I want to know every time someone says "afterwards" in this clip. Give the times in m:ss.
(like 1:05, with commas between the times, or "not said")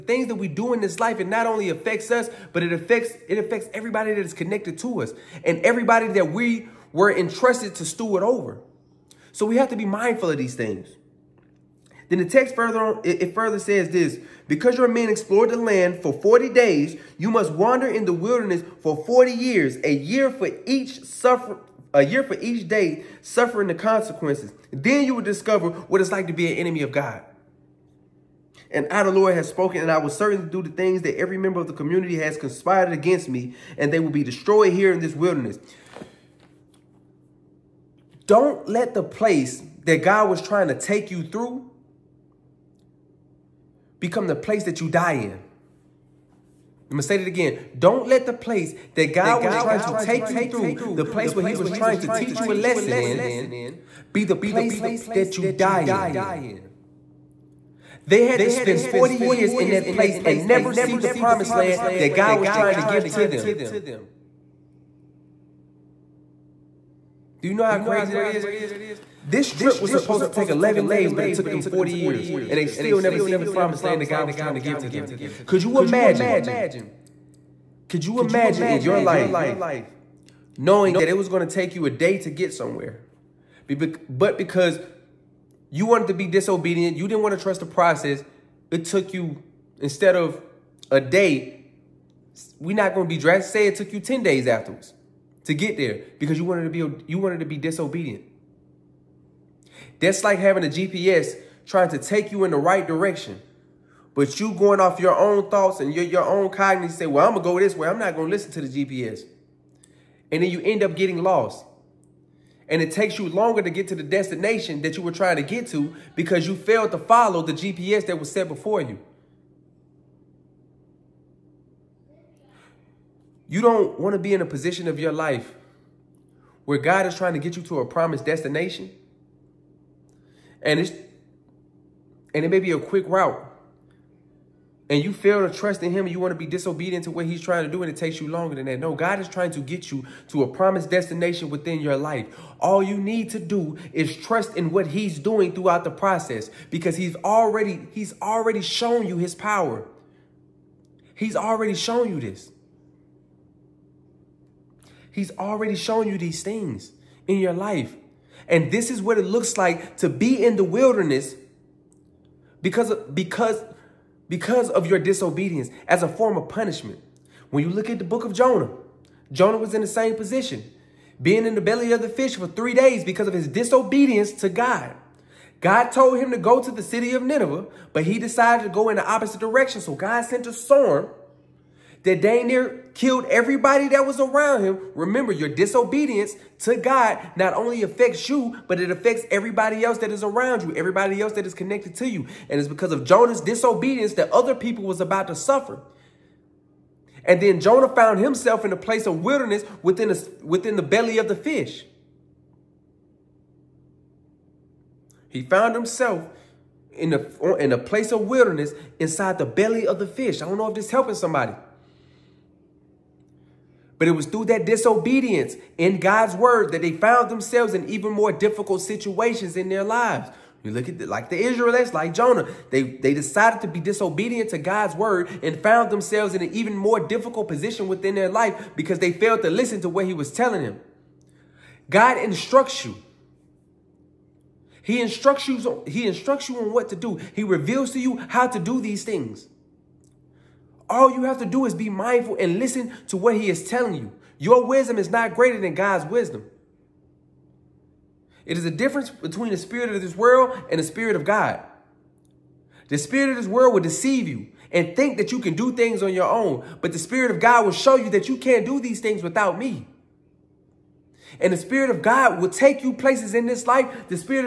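1:34.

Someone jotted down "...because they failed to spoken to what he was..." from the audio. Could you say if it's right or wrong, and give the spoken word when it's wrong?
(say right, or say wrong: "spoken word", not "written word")
wrong: "listen", not "spoken".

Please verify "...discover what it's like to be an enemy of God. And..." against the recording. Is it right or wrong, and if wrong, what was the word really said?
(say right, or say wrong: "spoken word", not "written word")
right.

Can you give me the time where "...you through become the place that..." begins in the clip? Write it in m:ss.
0:41.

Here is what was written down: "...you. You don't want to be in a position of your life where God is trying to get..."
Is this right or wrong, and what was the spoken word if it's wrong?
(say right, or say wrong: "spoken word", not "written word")
right.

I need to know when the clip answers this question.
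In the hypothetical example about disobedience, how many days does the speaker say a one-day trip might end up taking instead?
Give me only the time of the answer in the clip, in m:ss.
1:34.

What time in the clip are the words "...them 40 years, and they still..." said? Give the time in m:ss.
1:11.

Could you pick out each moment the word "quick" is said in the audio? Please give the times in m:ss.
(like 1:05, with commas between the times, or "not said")
2:12.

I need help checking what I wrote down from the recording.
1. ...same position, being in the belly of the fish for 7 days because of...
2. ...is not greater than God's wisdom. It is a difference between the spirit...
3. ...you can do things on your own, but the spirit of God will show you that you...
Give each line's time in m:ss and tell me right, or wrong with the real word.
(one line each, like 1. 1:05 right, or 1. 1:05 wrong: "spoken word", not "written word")
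1. 2:49 wrong: "3", not "7"
2. 4:04 right
3. 4:15 right.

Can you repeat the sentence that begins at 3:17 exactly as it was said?
And then Jonah found himself in a place of wilderness within, a, within the belly of the fish.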